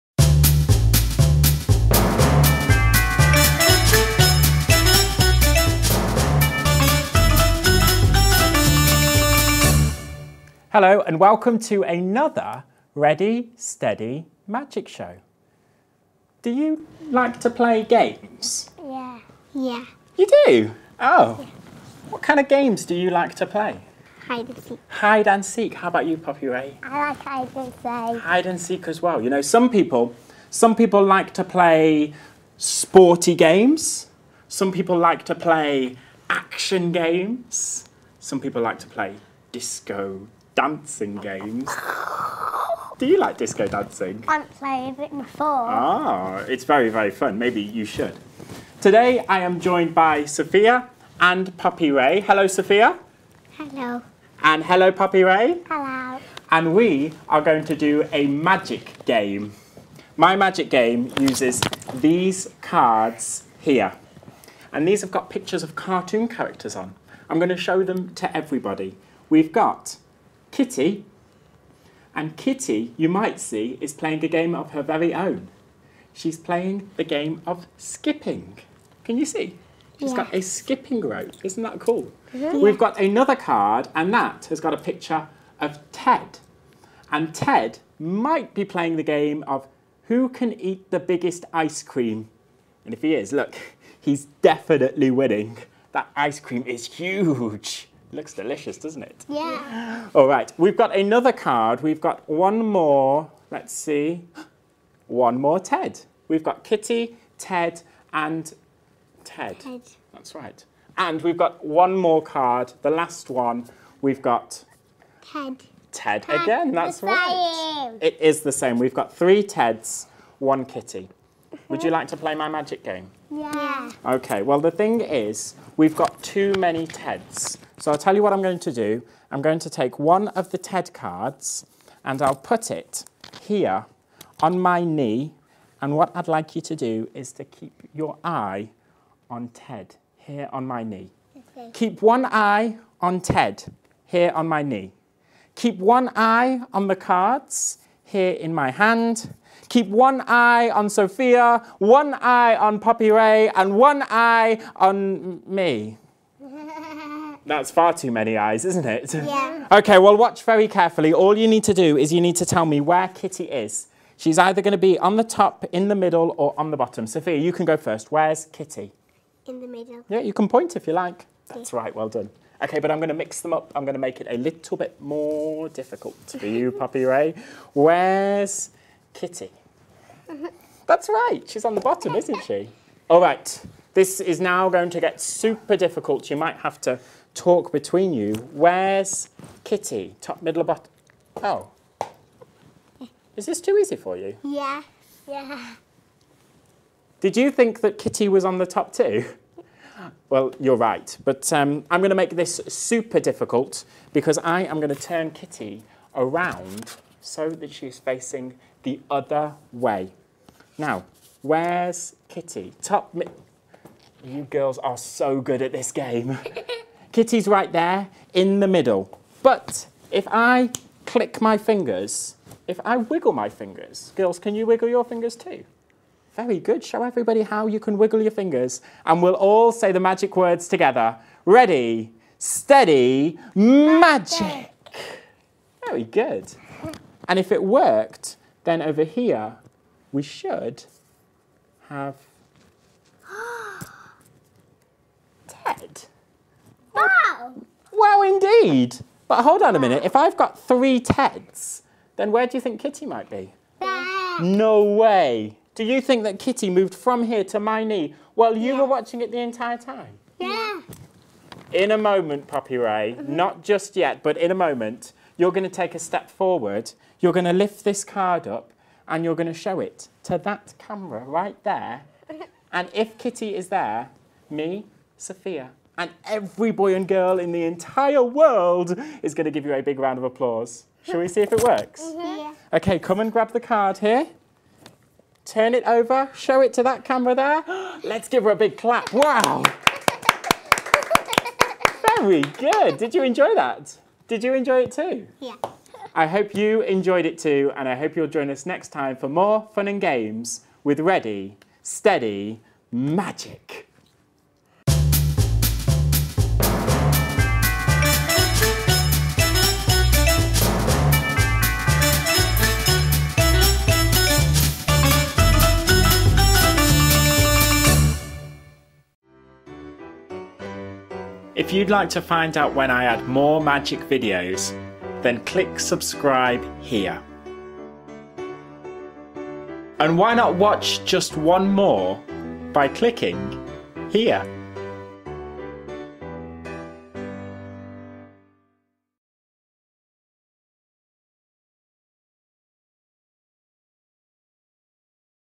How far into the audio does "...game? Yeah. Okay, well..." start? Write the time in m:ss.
2:02.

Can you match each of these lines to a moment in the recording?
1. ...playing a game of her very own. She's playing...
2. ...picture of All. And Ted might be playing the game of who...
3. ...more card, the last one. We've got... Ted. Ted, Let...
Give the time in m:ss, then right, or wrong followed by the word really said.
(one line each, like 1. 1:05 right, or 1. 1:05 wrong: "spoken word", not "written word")
1. 1:13 right
2. 1:24 wrong: "Ted", not "All"
3. 1:51 wrong: "Ted", not "Let".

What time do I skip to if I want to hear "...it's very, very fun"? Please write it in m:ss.
0:46.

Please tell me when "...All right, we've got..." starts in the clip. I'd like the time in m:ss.
1:40.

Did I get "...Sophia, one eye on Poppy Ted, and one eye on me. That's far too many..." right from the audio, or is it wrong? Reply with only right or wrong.
wrong.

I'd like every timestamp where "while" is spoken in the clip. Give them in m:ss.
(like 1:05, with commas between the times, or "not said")
4:18.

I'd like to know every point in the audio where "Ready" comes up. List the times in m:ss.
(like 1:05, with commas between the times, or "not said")
0:12, 3:51, 5:01.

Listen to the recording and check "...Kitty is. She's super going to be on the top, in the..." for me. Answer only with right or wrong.
wrong.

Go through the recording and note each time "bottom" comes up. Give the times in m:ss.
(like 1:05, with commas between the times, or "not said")
2:46, 3:01, 3:10.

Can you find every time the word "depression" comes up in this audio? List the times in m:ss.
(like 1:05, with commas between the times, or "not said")
not said.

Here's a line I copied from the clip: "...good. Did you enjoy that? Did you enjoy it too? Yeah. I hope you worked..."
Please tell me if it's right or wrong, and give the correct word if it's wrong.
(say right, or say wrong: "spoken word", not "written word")
wrong: "enjoyed", not "worked".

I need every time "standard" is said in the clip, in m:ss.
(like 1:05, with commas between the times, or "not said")
not said.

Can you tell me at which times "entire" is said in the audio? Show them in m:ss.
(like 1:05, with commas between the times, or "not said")
4:19, 4:37.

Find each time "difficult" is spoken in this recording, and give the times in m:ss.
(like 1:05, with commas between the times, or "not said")
2:55, 3:05, 3:23.